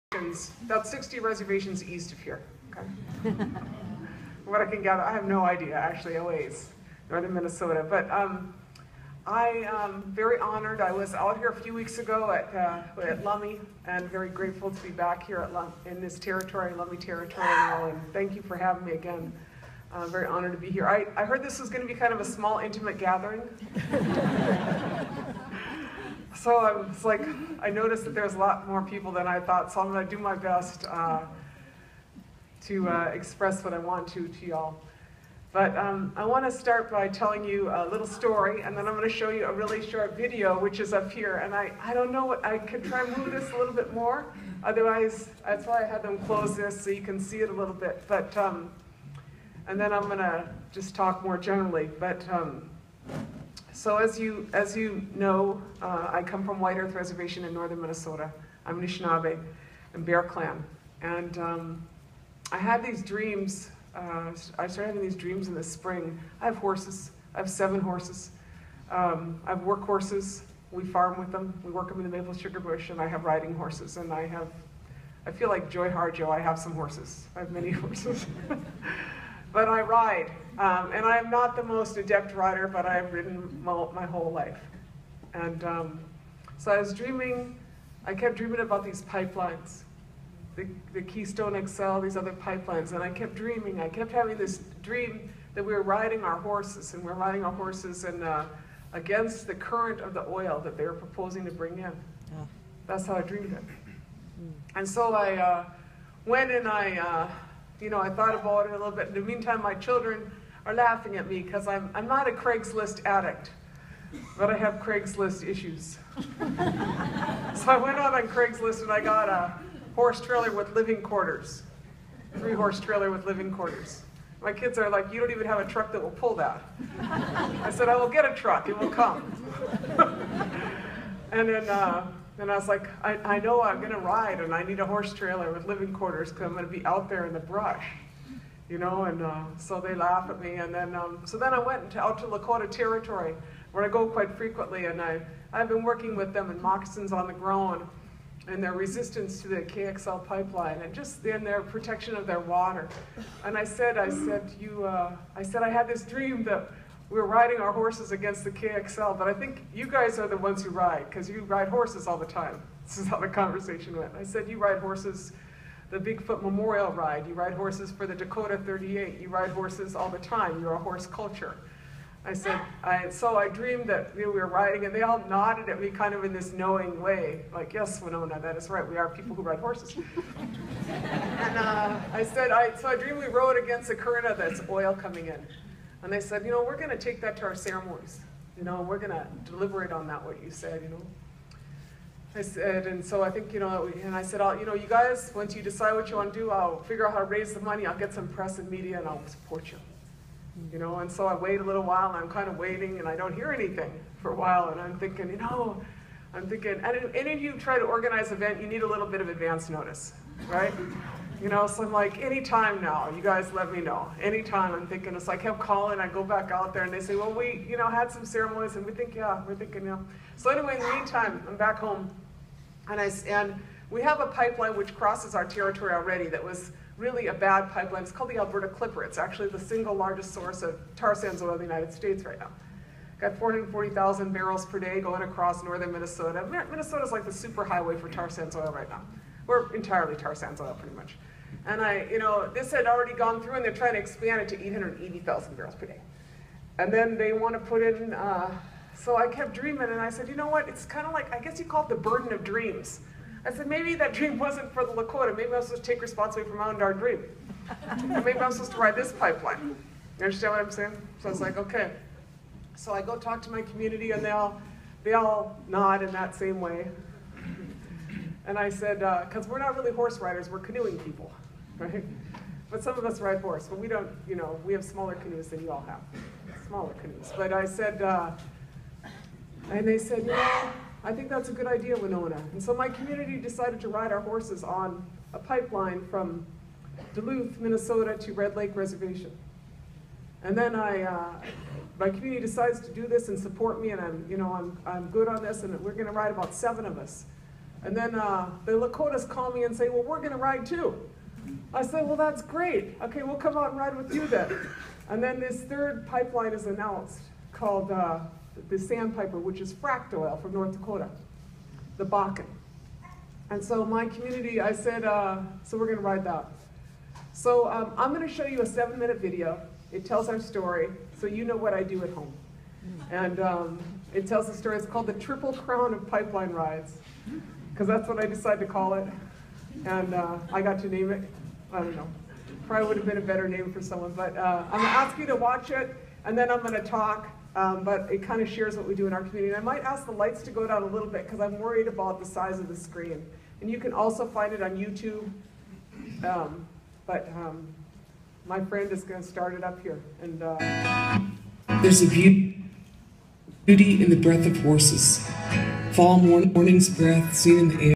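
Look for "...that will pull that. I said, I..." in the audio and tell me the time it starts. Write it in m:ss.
2:05.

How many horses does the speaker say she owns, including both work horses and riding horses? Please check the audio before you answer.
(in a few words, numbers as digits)
7.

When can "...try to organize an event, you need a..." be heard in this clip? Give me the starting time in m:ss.
3:27.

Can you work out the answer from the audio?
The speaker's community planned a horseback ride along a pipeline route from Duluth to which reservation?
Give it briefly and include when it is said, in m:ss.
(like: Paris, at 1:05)
Red Lake Reservation, at 4:48.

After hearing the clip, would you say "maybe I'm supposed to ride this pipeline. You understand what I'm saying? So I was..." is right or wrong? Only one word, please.
right.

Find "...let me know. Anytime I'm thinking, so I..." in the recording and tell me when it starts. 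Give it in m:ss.
3:33.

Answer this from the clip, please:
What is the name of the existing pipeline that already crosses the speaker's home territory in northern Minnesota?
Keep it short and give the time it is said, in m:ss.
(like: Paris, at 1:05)
Alberta Clipper, at 3:48.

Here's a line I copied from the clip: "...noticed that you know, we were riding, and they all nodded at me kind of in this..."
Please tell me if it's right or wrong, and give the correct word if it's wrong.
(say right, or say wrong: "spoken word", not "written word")
wrong: "dreamed", not "noticed".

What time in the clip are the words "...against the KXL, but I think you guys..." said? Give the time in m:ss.
2:38.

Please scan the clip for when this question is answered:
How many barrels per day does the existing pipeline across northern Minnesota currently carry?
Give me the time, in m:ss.
3:53.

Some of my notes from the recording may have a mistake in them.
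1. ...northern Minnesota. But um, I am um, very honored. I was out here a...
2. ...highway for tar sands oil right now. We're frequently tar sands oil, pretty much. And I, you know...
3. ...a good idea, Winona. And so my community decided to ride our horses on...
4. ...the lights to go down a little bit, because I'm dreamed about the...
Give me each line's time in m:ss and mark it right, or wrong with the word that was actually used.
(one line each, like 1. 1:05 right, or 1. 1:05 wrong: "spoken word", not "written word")
1. 0:07 right
2. 3:57 wrong: "entirely", not "frequently"
3. 4:41 right
4. 5:40 wrong: "worried", not "dreamed".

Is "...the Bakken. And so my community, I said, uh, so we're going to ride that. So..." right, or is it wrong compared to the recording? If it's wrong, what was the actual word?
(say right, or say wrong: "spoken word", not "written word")
right.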